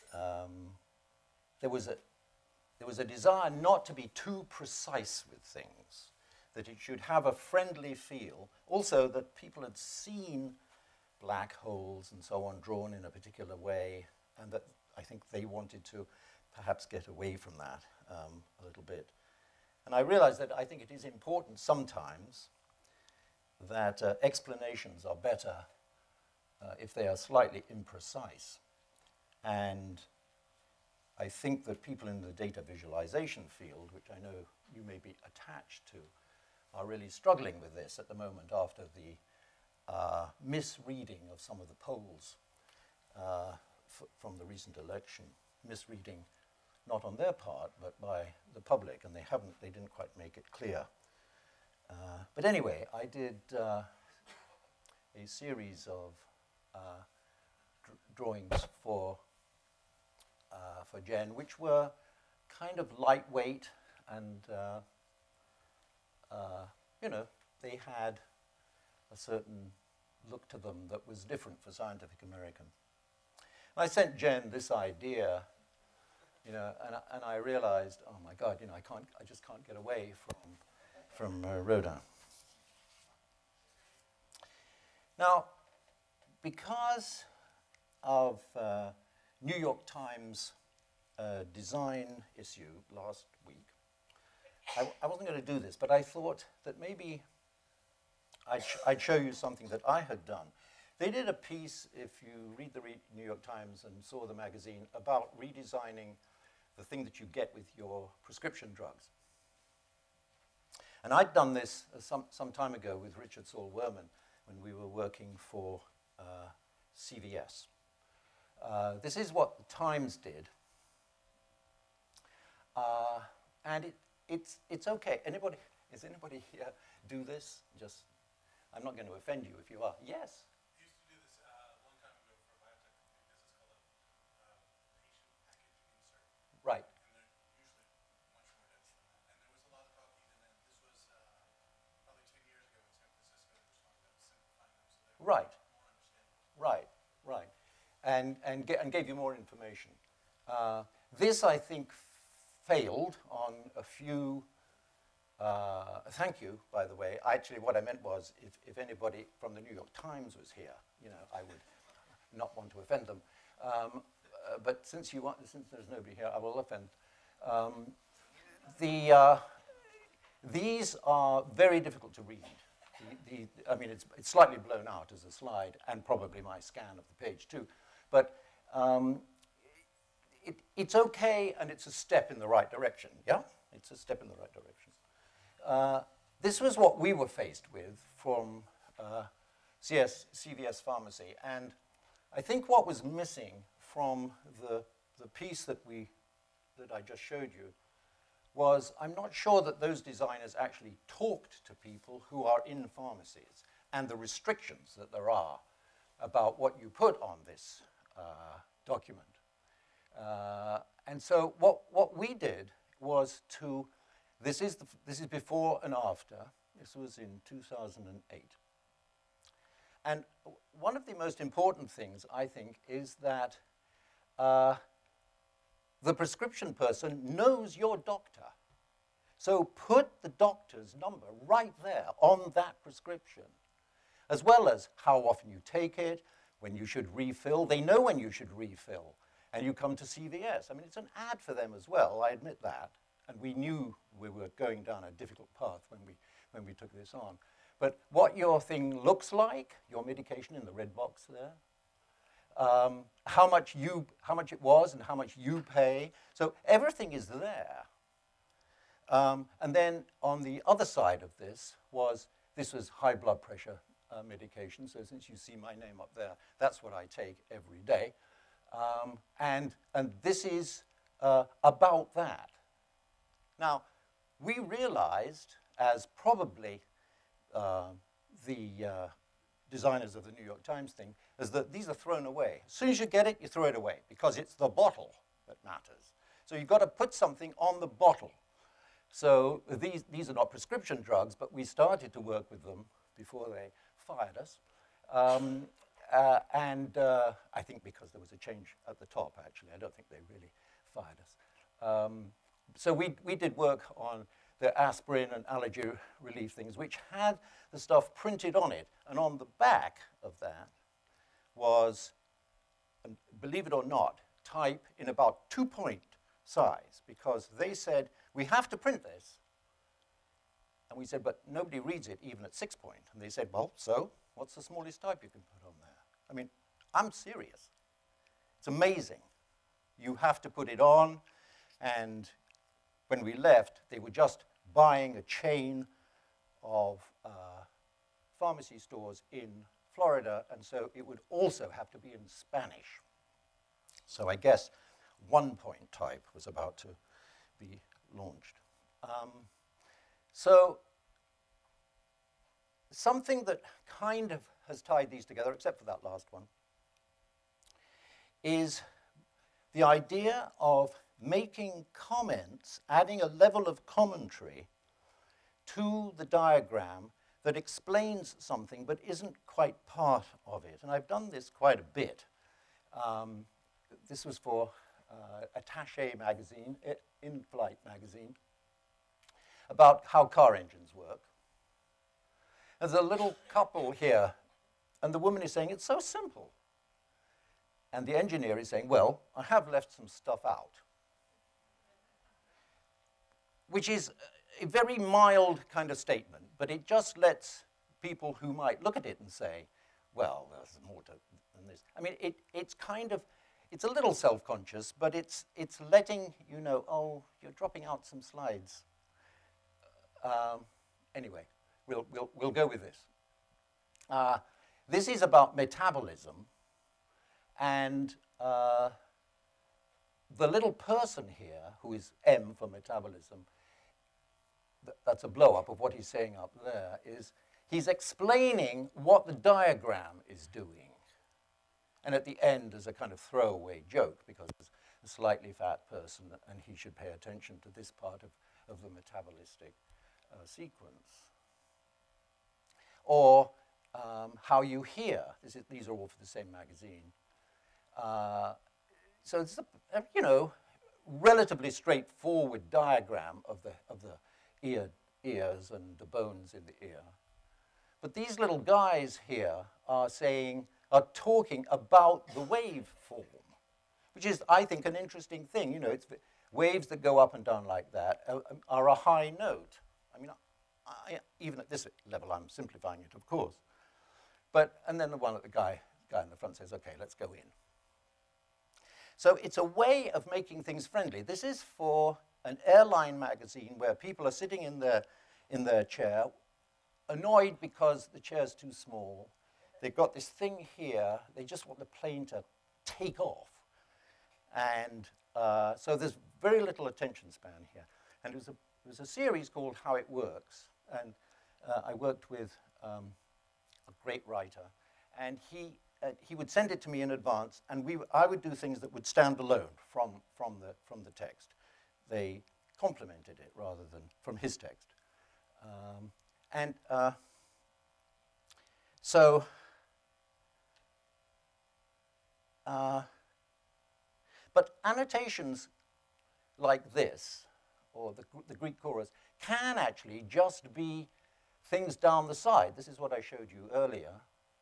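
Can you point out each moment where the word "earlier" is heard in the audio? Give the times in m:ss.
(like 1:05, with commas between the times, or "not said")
8:53.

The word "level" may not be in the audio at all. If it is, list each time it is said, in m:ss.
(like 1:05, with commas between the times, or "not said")
6:03, 7:52.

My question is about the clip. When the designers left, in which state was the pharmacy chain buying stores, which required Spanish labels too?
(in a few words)
Florida.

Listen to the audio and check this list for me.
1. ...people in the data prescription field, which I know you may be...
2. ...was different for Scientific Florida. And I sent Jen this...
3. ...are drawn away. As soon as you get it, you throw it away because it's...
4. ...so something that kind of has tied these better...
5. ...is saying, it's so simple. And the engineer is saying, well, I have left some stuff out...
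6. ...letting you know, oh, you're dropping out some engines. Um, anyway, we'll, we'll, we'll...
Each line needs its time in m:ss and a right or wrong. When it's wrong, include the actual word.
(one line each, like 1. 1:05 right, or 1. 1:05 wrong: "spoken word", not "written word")
1. 0:31 wrong: "visualization", not "prescription"
2. 1:11 wrong: "American", not "Florida"
3. 4:41 wrong: "thrown", not "drawn"
4. 5:50 wrong: "together", not "better"
5. 6:25 right
6. 6:45 wrong: "slides", not "engines".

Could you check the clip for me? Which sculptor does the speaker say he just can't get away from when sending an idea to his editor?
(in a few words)
Rodin.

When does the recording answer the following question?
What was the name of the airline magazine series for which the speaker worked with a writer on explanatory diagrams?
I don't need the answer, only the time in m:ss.
8:19.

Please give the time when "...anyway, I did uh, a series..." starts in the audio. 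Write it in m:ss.
0:52.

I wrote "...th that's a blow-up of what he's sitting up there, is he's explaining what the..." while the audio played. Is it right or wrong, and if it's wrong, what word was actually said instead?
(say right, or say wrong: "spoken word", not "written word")
wrong: "saying", not "sitting".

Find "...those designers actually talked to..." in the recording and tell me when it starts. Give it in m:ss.
3:19.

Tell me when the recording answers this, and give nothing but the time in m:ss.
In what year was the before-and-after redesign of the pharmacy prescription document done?
3:37.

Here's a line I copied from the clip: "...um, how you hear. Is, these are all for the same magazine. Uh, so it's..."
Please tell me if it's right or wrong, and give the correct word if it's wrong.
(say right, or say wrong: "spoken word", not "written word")
right.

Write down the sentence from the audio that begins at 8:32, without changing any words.
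They complemented it rather than from his text.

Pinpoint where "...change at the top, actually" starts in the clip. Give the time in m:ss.
4:58.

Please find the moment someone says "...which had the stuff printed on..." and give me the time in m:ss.
5:06.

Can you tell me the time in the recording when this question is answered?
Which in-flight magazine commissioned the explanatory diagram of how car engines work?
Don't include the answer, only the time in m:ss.
6:15.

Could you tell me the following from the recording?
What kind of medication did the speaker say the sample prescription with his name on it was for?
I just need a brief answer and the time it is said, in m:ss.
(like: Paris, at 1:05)
high blood pressure, at 4:22.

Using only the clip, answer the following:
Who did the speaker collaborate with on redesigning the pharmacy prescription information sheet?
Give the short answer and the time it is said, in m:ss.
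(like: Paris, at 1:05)
Richard Saul Wurman, at 1:53.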